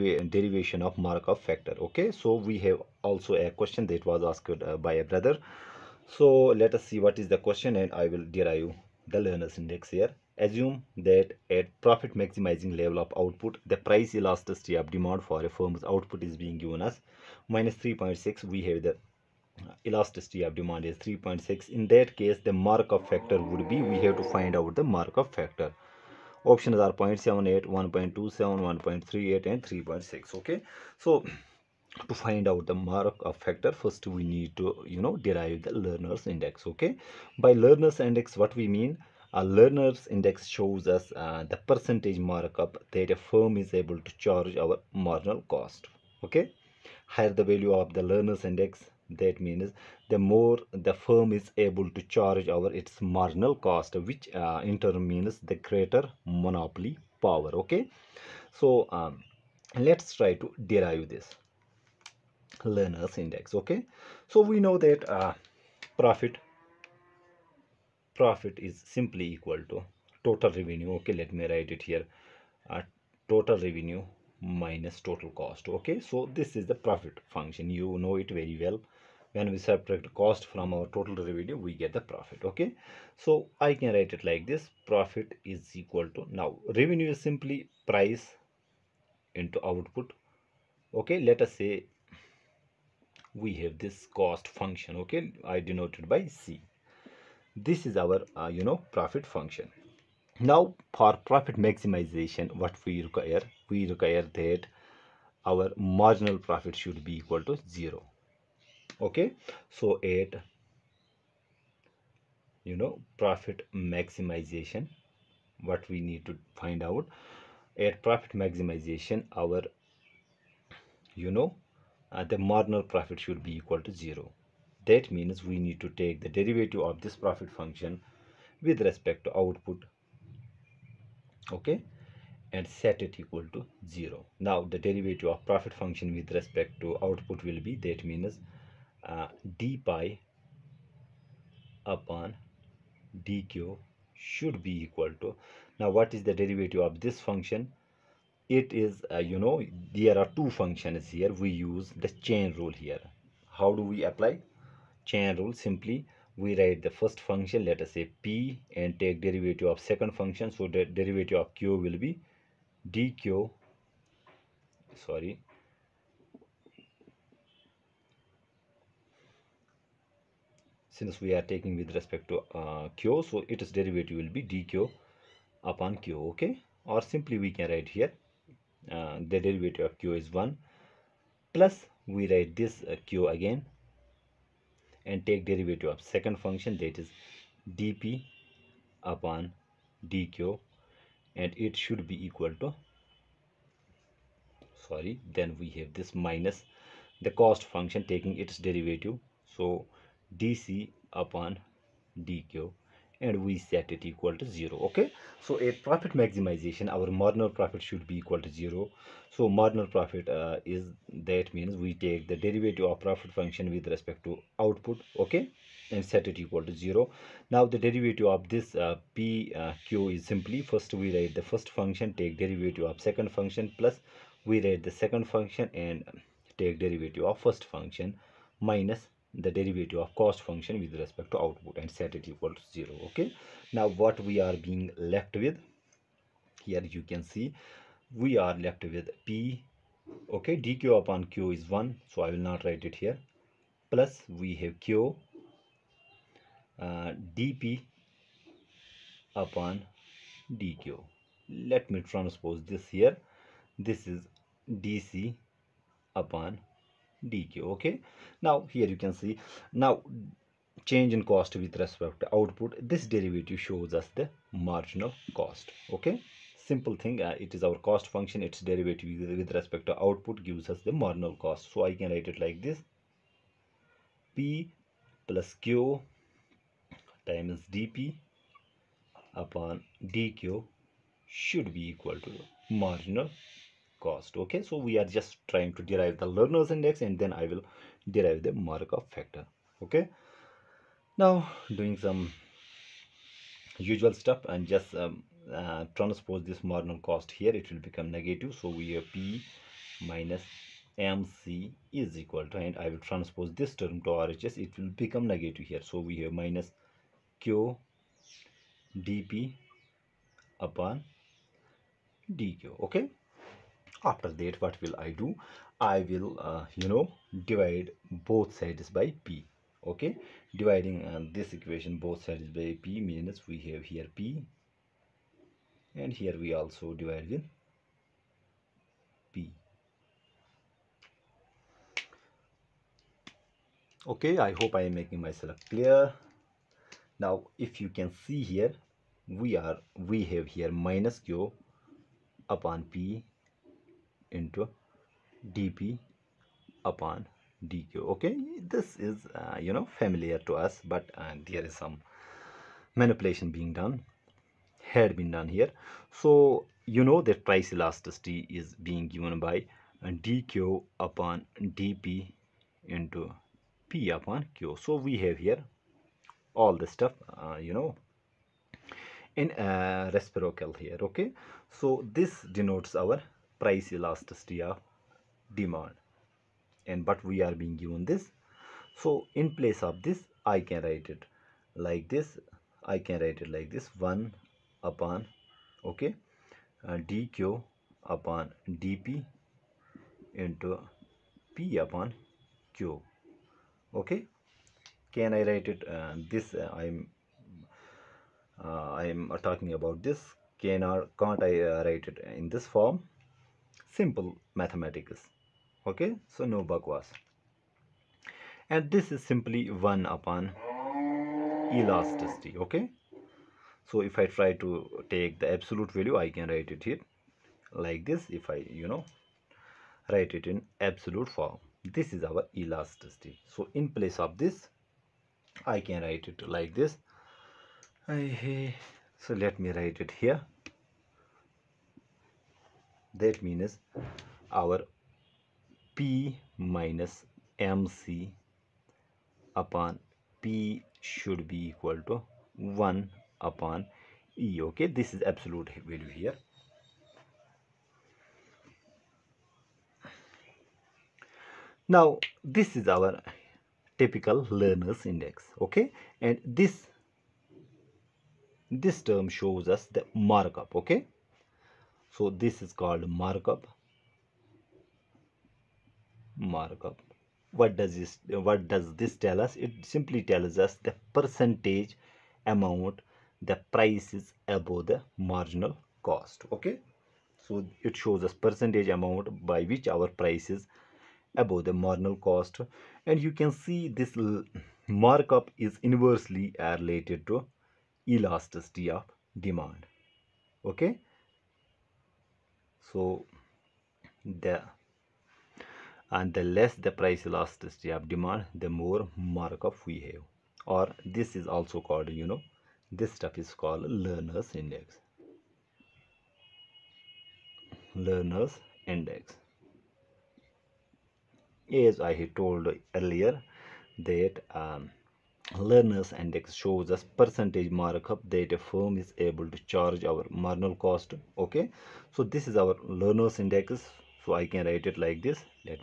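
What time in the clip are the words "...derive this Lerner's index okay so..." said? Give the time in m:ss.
1:00.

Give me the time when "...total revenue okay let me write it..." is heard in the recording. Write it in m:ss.
1:10.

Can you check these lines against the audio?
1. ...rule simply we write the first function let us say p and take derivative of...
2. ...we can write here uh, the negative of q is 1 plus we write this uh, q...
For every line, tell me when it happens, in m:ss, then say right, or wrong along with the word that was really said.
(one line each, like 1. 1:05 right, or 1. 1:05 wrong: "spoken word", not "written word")
1. 2:35 right
2. 2:57 wrong: "derivative", not "negative".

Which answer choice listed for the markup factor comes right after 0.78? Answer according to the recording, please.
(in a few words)
1.27.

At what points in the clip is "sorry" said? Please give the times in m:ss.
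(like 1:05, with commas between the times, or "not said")
2:45, 3:14.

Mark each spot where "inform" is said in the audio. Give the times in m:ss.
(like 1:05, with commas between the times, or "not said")
not said.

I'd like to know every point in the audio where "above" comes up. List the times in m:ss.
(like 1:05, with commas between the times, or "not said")
7:54, 8:01.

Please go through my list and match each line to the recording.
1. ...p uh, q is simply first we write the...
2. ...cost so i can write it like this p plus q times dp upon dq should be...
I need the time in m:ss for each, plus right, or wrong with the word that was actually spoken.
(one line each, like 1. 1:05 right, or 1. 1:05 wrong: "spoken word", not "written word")
1. 3:39 right
2. 4:31 right.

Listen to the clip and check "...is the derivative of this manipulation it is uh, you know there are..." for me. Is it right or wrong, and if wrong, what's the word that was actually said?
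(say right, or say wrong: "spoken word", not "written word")
wrong: "function", not "manipulation".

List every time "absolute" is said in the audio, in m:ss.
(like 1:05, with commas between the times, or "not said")
6:55, 7:00, 7:25.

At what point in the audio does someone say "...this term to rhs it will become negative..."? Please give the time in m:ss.
5:03.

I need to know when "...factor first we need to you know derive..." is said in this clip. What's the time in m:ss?
0:33.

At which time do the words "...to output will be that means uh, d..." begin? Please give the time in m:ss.
2:16.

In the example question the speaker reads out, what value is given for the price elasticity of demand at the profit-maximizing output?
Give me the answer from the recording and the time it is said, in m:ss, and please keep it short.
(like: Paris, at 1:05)
-3.6, at 0:17.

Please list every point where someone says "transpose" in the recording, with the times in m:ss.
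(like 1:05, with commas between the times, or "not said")
4:12, 4:55, 5:03.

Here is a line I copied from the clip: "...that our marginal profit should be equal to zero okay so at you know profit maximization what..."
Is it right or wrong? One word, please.
right.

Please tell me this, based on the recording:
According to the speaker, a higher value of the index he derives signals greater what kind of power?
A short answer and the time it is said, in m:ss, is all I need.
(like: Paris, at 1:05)
Monopoly power, at 0:56.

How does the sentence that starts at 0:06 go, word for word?
So let us see what is the question and I will derive the Lerner's index here.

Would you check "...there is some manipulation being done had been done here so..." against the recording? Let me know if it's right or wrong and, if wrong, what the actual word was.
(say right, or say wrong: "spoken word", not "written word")
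right.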